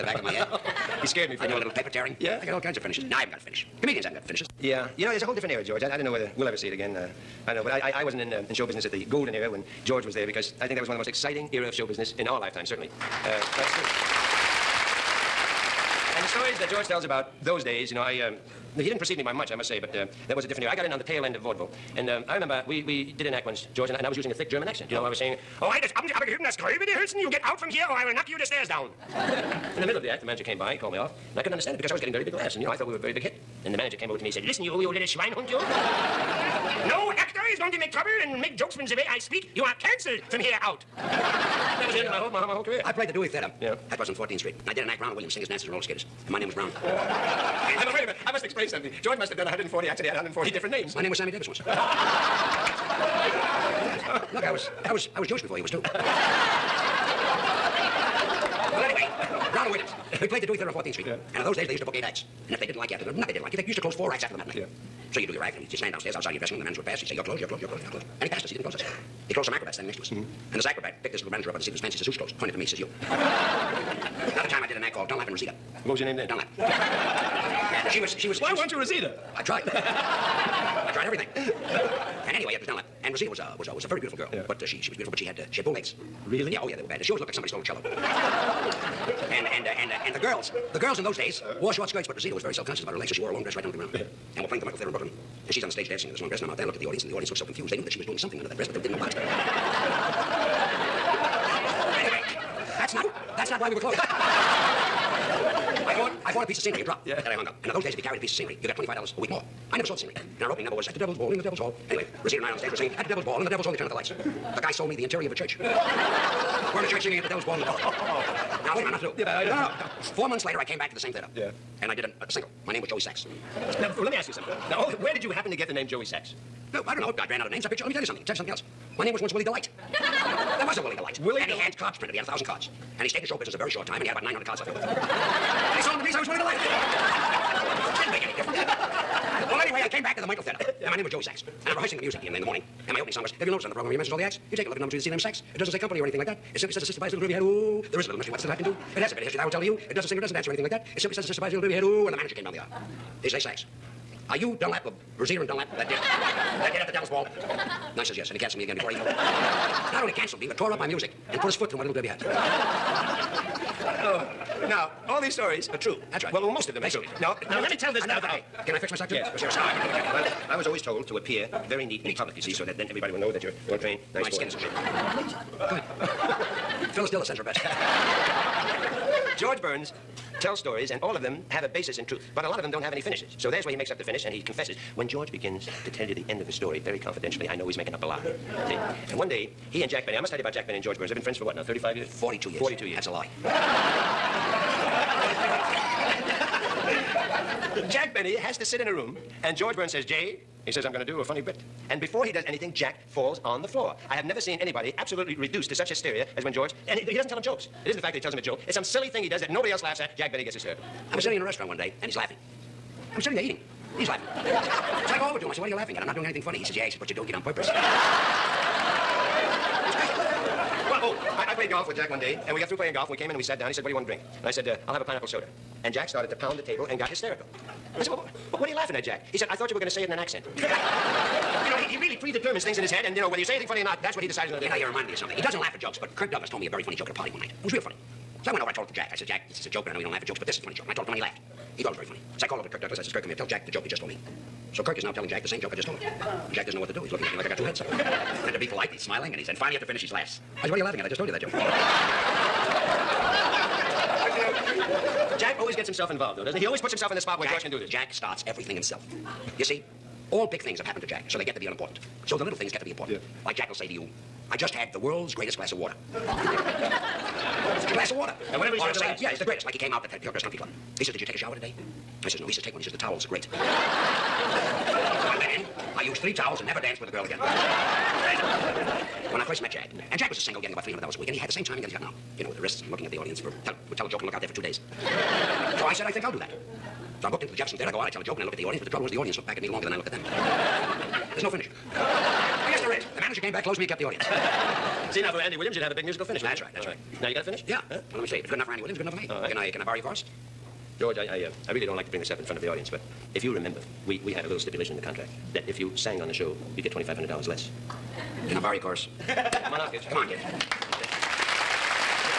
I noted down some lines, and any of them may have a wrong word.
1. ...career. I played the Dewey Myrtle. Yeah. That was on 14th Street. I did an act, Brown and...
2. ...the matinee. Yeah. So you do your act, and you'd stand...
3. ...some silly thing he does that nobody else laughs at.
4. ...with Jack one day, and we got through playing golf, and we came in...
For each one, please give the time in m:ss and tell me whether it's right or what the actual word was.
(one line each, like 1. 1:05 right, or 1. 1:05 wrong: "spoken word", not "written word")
1. 0:42 wrong: "Theater", not "Myrtle"
2. 1:04 right
3. 3:28 right
4. 3:41 right.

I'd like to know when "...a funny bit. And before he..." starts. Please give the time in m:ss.
3:21.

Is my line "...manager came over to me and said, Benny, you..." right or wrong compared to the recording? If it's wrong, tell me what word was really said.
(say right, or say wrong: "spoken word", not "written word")
wrong: "Listen", not "Benny".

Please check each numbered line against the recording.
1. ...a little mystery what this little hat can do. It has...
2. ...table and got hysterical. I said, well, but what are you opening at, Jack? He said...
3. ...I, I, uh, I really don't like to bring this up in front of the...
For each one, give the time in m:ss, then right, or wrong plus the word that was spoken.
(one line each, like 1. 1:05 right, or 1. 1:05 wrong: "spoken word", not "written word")
1. 2:28 right
2. 3:46 wrong: "laughing", not "opening"
3. 5:01 right.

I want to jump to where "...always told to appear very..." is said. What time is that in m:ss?
2:50.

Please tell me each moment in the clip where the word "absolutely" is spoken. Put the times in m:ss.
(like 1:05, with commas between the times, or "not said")
3:24.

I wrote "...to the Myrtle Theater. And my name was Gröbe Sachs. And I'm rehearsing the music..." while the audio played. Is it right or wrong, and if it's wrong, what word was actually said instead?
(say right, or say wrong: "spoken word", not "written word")
wrong: "Joey", not "Gröbe".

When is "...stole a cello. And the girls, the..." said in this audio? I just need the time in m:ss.
1:27.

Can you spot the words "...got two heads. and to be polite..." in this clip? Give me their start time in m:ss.
4:07.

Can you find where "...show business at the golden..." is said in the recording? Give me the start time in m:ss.
0:08.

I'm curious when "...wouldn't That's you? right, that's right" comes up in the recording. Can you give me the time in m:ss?
4:56.